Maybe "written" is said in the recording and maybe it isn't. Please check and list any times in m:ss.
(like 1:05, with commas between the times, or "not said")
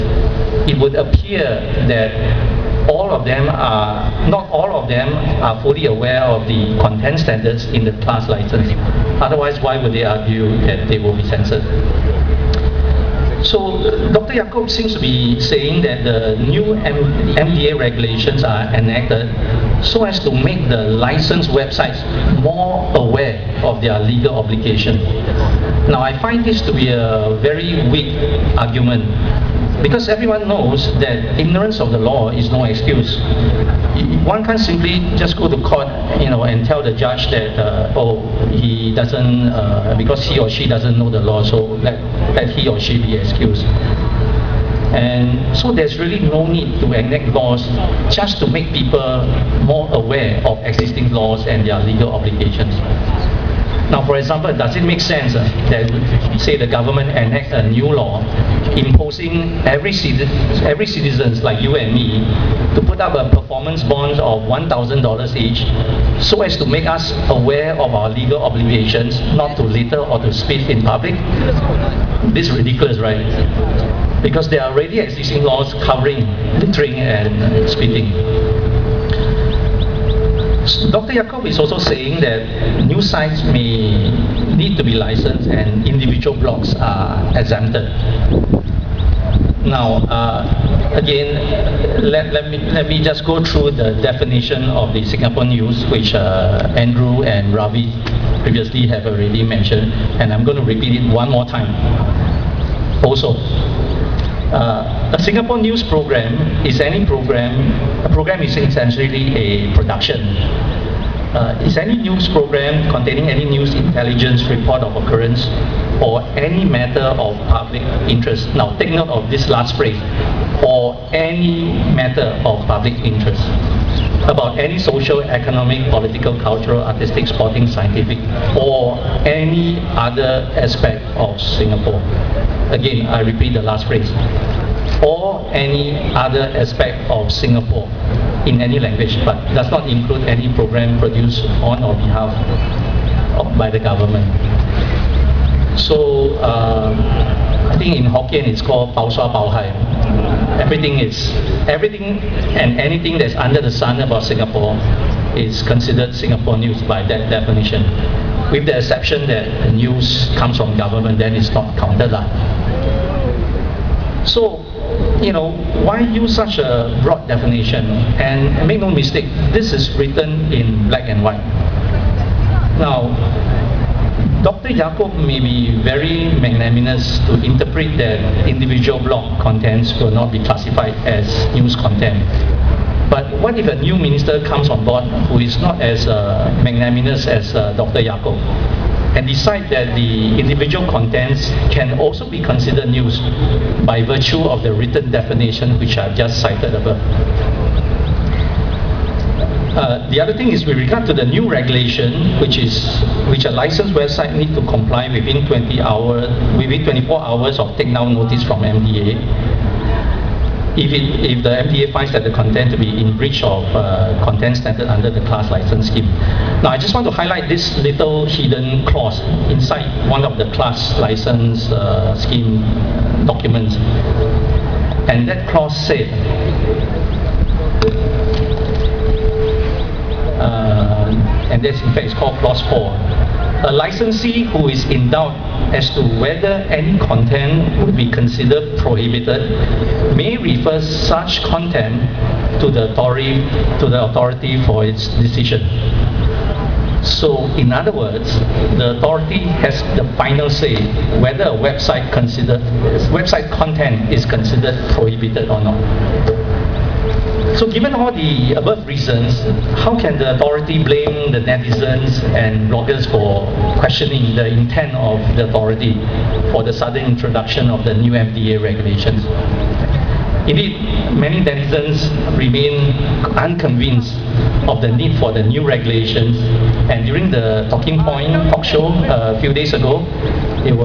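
2:49, 3:14.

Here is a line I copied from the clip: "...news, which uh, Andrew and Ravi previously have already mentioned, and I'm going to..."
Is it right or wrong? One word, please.
right.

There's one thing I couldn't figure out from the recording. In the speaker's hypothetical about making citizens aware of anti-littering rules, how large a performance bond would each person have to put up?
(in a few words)
$1,000.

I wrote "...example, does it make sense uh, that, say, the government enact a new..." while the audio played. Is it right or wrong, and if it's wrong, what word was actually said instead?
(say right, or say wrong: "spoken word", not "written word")
right.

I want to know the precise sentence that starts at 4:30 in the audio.
Indeed, many netizens remain unconvinced of the need for the new regulations.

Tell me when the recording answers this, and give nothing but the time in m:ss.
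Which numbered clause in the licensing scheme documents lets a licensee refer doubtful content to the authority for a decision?
3:52.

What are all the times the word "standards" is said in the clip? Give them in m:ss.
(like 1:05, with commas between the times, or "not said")
0:07, 3:34.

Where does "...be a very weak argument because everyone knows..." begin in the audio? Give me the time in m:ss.
0:26.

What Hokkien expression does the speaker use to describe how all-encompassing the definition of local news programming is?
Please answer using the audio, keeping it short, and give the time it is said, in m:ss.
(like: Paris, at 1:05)
Pao Sua Pao Hai, at 2:28.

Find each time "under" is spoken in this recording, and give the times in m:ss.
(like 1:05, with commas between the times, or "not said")
2:33, 3:34.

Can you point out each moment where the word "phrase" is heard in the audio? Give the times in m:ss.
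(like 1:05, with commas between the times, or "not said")
1:59, 2:13.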